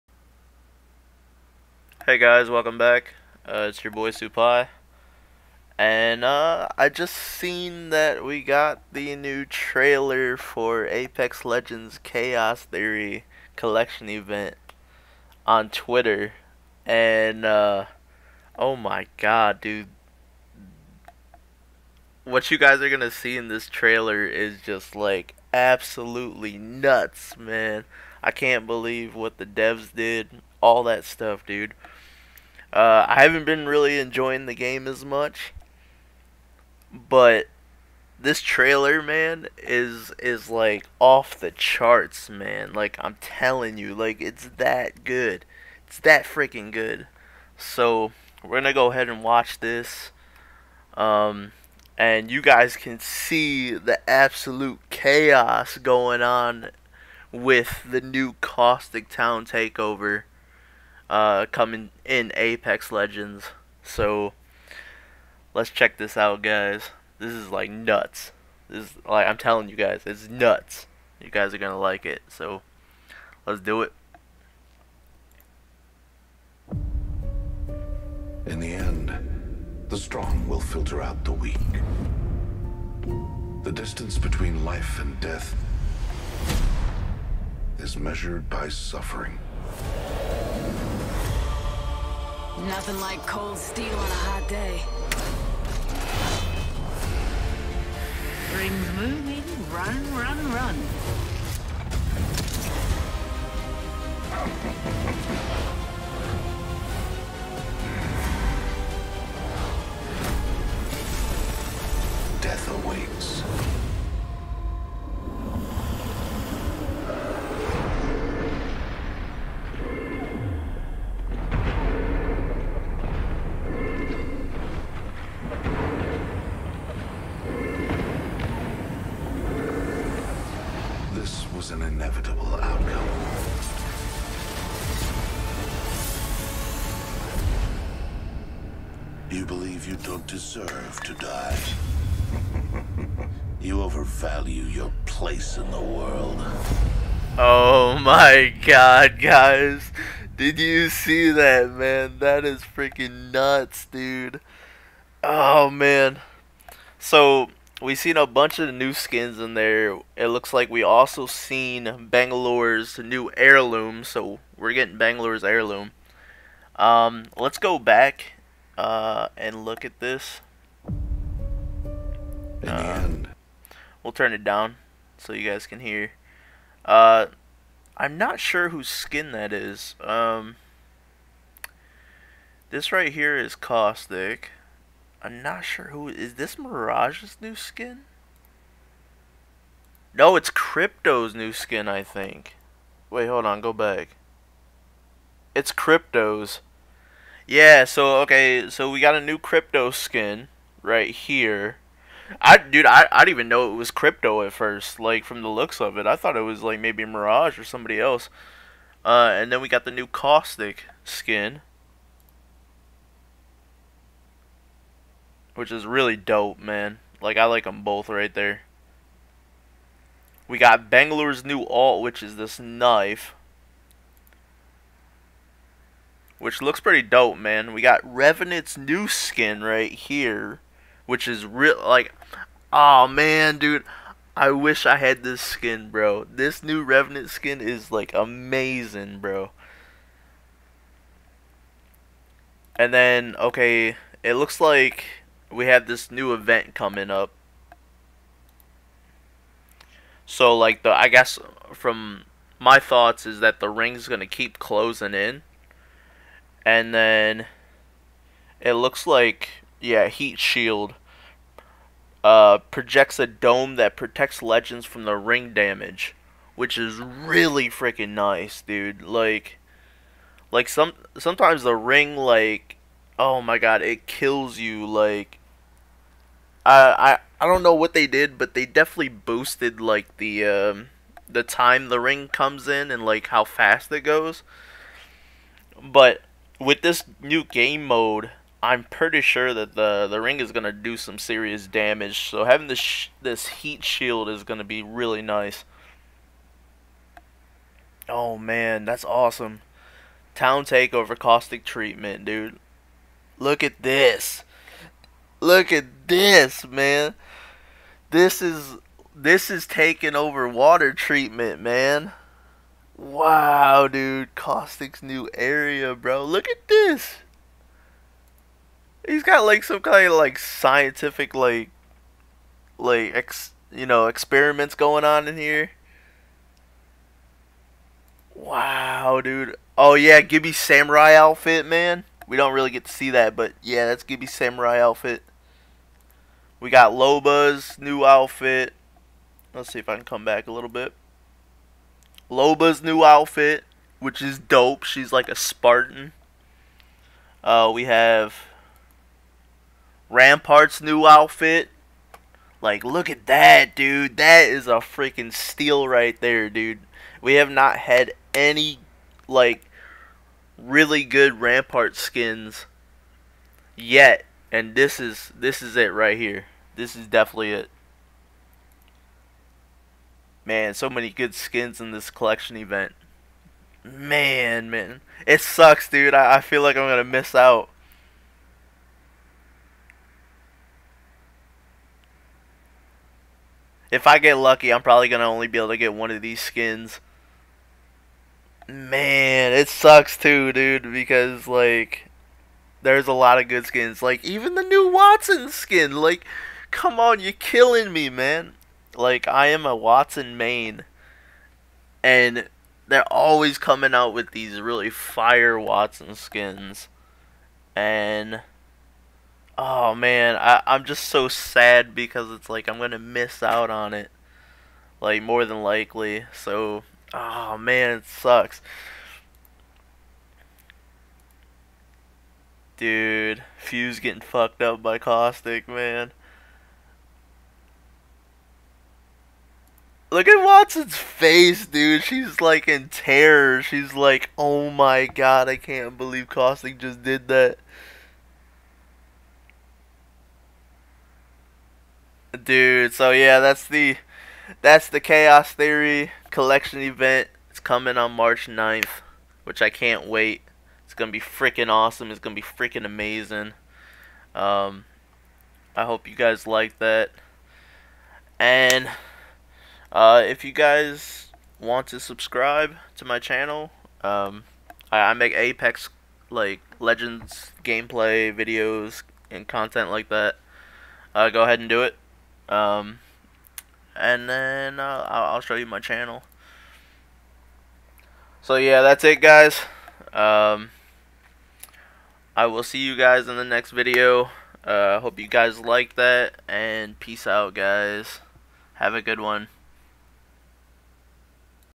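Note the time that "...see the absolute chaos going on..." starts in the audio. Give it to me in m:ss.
0:52.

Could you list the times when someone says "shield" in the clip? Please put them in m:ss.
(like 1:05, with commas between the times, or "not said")
4:20, 4:53.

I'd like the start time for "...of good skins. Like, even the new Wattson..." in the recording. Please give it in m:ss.
6:33.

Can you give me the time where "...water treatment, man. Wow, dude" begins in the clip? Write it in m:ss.
5:10.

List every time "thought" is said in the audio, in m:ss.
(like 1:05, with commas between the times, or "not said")
3:26, 4:12.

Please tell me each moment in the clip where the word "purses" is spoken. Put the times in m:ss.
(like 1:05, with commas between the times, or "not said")
not said.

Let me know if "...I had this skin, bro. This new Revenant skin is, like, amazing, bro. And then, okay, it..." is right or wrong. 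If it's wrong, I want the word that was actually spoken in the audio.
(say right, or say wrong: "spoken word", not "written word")
right.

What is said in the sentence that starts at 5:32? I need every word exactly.
We don't really get to see that, but yeah, that's Gibby samurai outfit.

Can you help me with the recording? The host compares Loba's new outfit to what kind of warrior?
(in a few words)
Spartan.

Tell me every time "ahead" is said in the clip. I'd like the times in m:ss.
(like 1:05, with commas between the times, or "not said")
0:48, 7:51.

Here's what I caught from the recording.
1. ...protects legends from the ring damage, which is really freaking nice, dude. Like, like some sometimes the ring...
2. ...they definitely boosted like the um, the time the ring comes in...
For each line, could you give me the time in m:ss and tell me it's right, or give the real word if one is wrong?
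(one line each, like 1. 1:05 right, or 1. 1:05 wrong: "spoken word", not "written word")
1. 4:23 right
2. 4:38 right.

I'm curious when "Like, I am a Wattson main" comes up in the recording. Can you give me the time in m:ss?
6:38.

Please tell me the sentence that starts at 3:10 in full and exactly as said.
No, it's Crypto's new skin, I think.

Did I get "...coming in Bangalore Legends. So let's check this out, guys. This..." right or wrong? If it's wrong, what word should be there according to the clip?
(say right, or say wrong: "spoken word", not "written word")
wrong: "Apex", not "Bangalore".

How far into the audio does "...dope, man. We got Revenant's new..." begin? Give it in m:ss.
3:47.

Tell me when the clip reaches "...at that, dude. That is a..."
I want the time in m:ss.
5:53.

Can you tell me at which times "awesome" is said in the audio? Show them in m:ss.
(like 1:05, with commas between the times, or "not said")
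4:59, 7:31.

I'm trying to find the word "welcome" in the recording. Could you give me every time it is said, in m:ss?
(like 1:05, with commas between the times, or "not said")
0:02.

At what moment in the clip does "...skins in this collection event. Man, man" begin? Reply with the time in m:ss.
6:11.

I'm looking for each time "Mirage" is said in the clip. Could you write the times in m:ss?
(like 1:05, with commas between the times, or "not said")
3:06, 3:27.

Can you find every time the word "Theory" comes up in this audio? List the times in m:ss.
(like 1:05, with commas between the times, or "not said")
0:12, 7:25.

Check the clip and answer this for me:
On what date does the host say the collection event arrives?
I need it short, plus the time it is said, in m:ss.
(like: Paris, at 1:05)
March 9, at 7:28.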